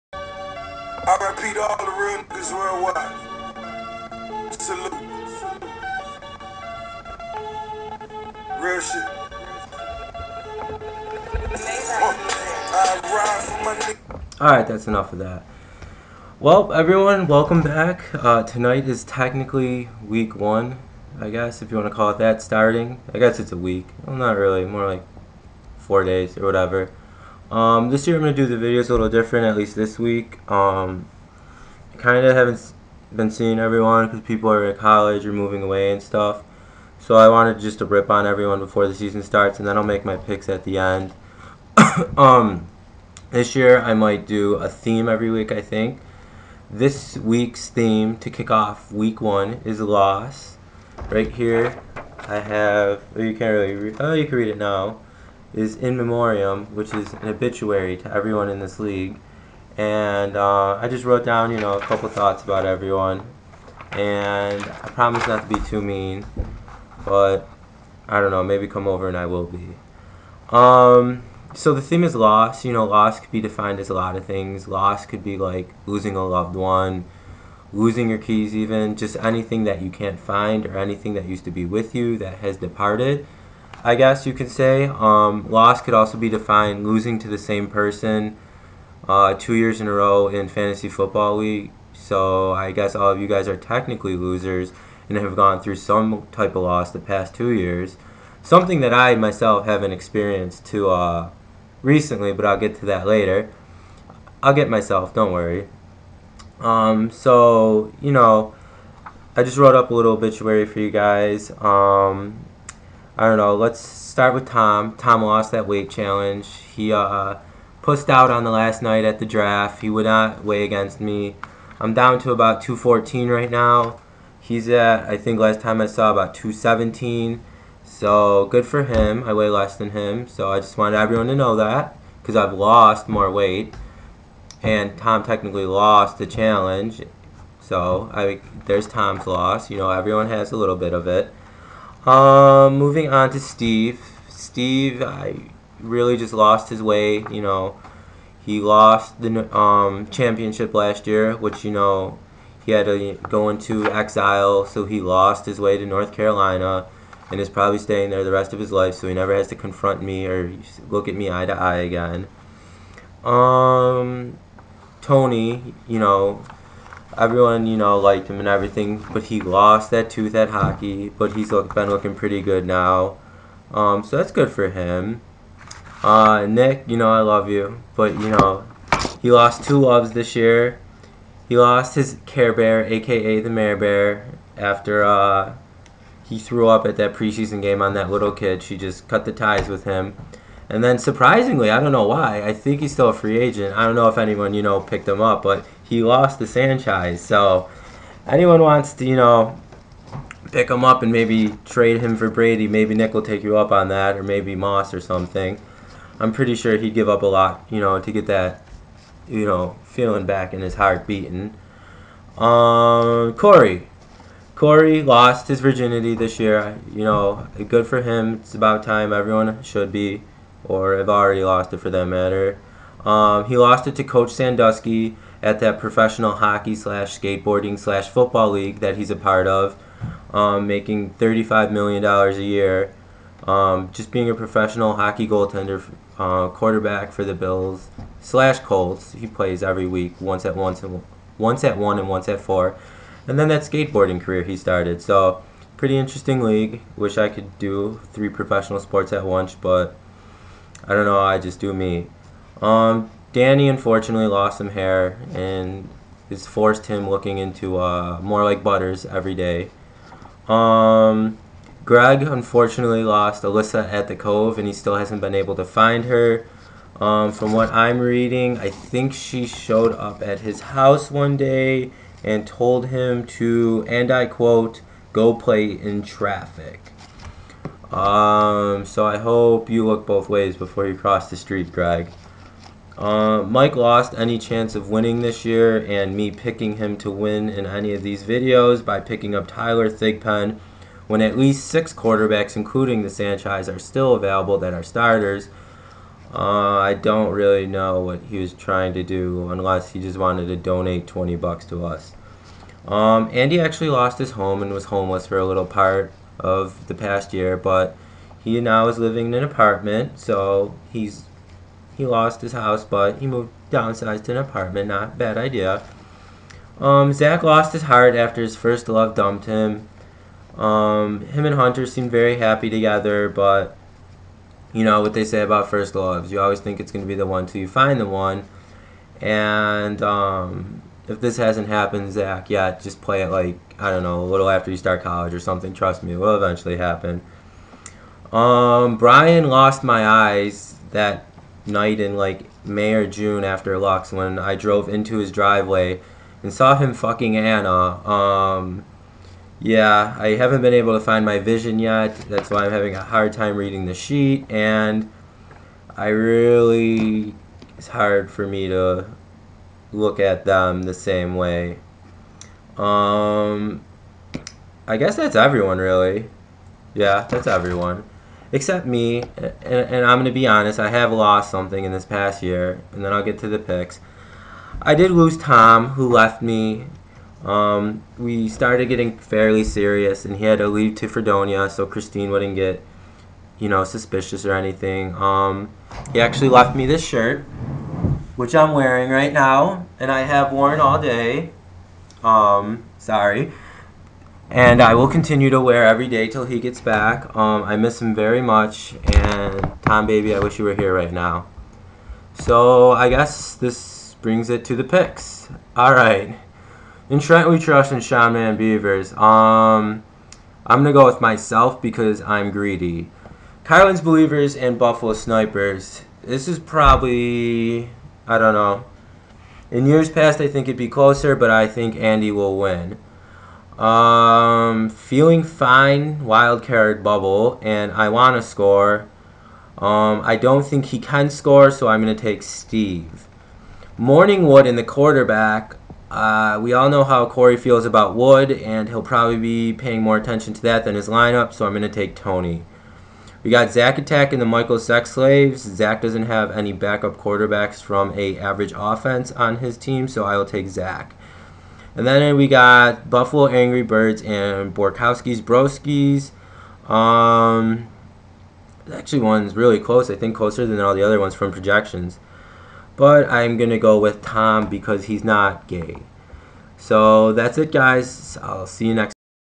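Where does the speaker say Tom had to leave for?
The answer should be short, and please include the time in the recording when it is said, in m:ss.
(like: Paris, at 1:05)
Fredonia, at 6:21.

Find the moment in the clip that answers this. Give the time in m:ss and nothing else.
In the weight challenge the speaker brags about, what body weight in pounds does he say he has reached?
2:02.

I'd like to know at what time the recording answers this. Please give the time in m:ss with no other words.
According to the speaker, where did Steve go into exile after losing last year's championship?
2:35.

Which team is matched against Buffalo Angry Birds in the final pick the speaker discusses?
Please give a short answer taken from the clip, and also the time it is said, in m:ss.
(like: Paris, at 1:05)
Borkowski's Broskies, at 7:34.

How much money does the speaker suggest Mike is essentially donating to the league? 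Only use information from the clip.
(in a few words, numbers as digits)
$20.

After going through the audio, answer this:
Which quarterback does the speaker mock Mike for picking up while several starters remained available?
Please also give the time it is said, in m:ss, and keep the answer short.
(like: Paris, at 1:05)
Tyler Thigpen, at 4:49.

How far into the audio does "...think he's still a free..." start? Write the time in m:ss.
3:12.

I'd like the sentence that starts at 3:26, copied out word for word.
I'm pretty sure he'd give up a lot, you know, to get that, you know, feeling back in his heart beating.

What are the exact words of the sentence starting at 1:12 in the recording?
You know, loss could be defined as a lot of things.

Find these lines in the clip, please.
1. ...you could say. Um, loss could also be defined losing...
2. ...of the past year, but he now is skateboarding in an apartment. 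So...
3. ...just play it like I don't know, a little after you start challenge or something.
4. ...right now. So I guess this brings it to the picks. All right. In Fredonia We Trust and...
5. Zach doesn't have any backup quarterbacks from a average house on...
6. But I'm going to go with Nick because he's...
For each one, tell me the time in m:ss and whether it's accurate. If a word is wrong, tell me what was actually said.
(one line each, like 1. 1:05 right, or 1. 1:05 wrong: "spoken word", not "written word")
1. 1:24 right
2. 5:06 wrong: "living", not "skateboarding"
3. 5:32 wrong: "college", not "challenge"
4. 6:40 wrong: "Trent", not "Fredonia"
5. 7:25 wrong: "offense", not "house"
6. 7:42 wrong: "Tom", not "Nick".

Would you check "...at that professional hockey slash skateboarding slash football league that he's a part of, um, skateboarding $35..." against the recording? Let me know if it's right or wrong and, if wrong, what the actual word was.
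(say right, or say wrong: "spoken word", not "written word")
wrong: "making", not "skateboarding".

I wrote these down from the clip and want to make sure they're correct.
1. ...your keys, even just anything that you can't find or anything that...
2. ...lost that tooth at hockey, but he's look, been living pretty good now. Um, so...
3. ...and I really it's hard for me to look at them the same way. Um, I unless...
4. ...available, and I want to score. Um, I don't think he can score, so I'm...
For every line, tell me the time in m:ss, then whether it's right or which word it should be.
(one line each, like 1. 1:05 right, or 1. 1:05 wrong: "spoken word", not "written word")
1. 1:18 right
2. 2:49 wrong: "looking", not "living"
3. 5:54 wrong: "guess", not "unless"
4. 7:07 wrong: "bubble", not "available".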